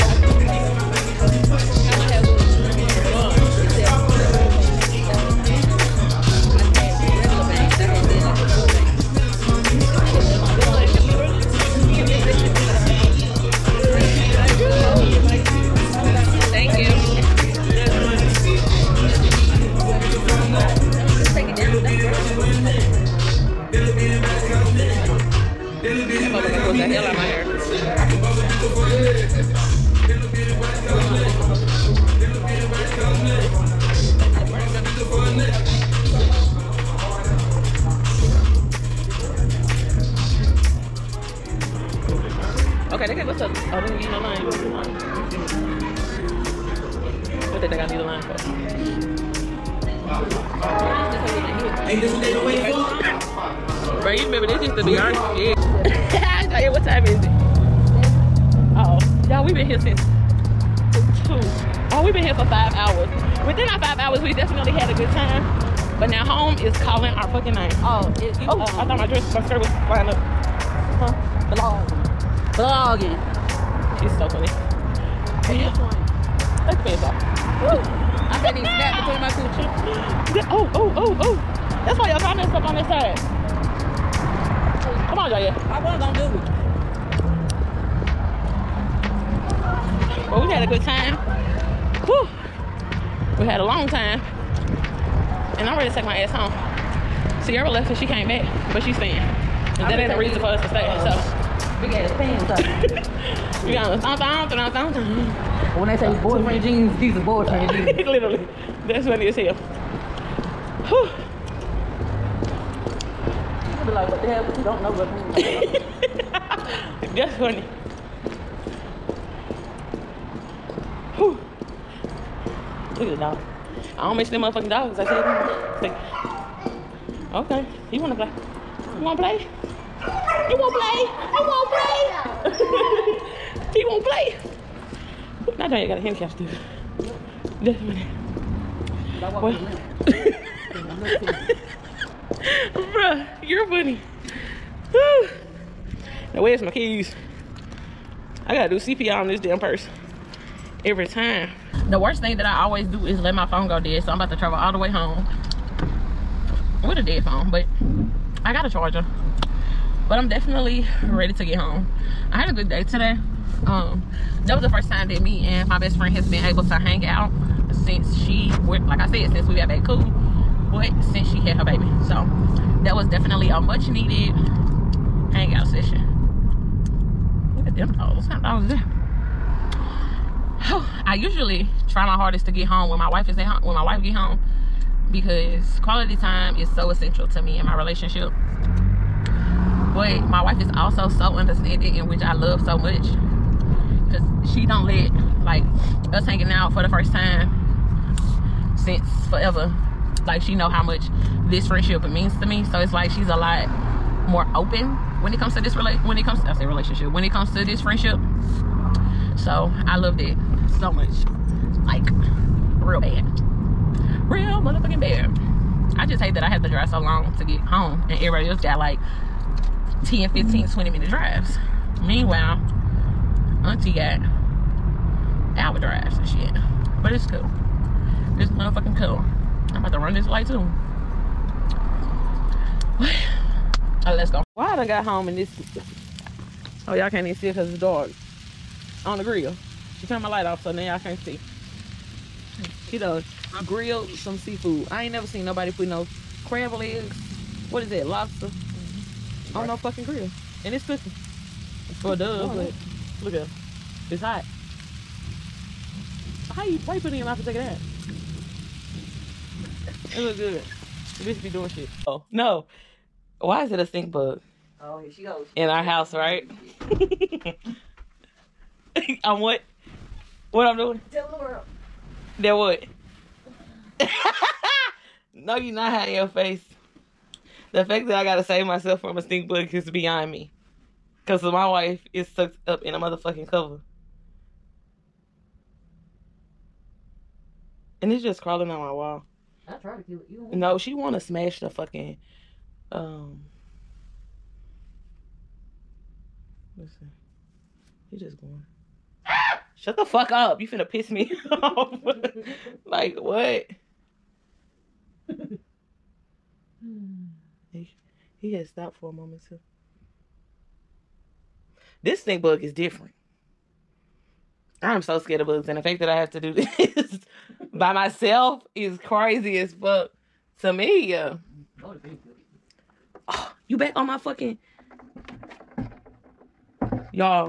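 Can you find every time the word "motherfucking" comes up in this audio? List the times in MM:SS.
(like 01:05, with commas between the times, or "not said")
02:04, 03:34, 03:48, 04:42.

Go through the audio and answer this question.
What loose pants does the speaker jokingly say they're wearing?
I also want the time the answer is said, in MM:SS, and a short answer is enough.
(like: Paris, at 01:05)
Boyfriend jeans, at 01:46.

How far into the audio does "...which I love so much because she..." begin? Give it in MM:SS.
03:12.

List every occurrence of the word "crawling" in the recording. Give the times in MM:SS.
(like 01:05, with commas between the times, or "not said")
04:48.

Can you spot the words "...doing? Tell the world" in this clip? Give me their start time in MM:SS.
04:30.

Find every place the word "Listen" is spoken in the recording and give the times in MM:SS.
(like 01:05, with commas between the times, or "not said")
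04:56.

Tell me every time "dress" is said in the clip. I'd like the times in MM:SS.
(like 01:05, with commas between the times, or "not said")
01:09.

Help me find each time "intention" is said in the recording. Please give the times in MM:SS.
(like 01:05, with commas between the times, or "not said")
not said.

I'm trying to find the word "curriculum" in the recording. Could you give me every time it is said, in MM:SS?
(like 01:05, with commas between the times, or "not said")
not said.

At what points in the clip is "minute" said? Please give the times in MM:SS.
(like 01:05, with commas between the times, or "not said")
02:17, 03:40.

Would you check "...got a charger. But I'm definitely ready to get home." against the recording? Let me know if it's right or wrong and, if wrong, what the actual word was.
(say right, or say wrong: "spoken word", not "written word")
right.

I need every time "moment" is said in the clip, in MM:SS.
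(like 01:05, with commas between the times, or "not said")
05:09.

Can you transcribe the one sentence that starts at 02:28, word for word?
I gotta do CPR on this damn person every time.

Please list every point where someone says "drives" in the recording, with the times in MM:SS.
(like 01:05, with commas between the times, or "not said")
03:36, 03:41, 03:45.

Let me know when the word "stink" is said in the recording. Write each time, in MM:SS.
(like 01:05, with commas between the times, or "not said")
04:23, 04:39, 05:12.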